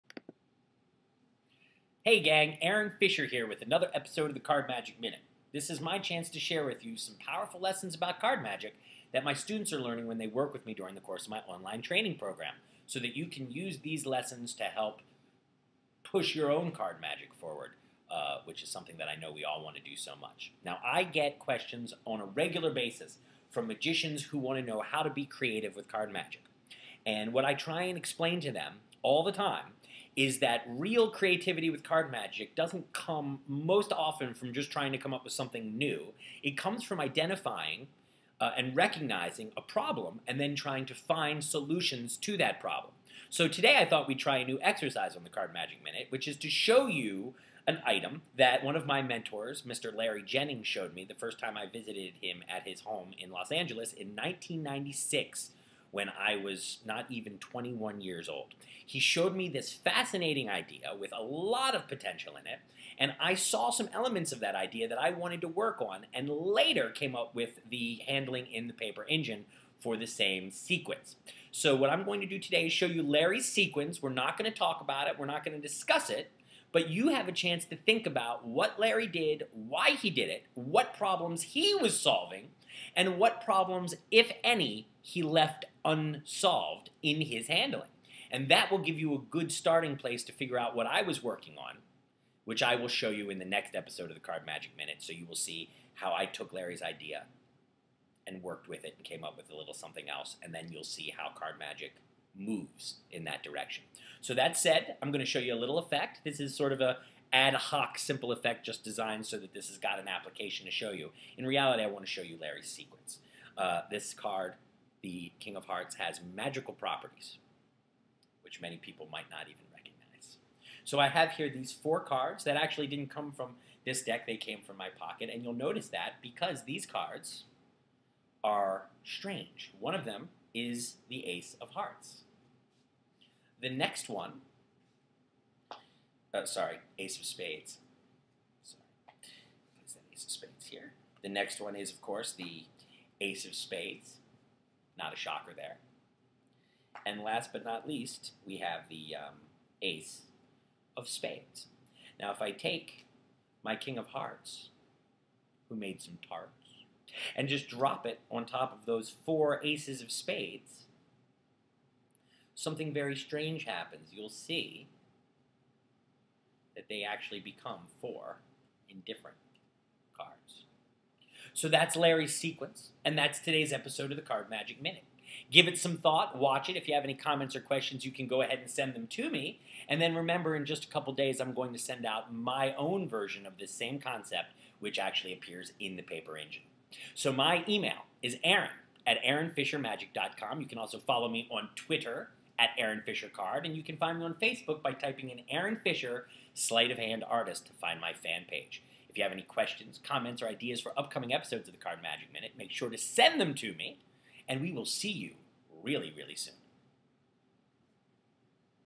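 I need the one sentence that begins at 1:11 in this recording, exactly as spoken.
So what I'm going to do today is show you Larry's sequence.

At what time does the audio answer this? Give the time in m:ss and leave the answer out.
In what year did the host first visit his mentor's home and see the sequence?
0:54.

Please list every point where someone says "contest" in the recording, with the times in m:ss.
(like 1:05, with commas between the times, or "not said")
not said.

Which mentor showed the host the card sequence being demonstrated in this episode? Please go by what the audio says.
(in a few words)
Larry Jennings.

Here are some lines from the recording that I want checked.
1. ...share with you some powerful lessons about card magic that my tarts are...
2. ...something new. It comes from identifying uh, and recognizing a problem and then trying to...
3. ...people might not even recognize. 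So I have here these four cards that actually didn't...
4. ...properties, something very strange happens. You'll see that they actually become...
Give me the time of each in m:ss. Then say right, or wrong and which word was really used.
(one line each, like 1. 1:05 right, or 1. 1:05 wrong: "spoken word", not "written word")
1. 0:06 wrong: "students", not "tarts"
2. 0:35 right
3. 1:58 right
4. 2:40 wrong: "spades", not "properties".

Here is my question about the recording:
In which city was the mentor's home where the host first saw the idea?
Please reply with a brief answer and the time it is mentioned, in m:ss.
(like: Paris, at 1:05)
Los Angeles, at 0:53.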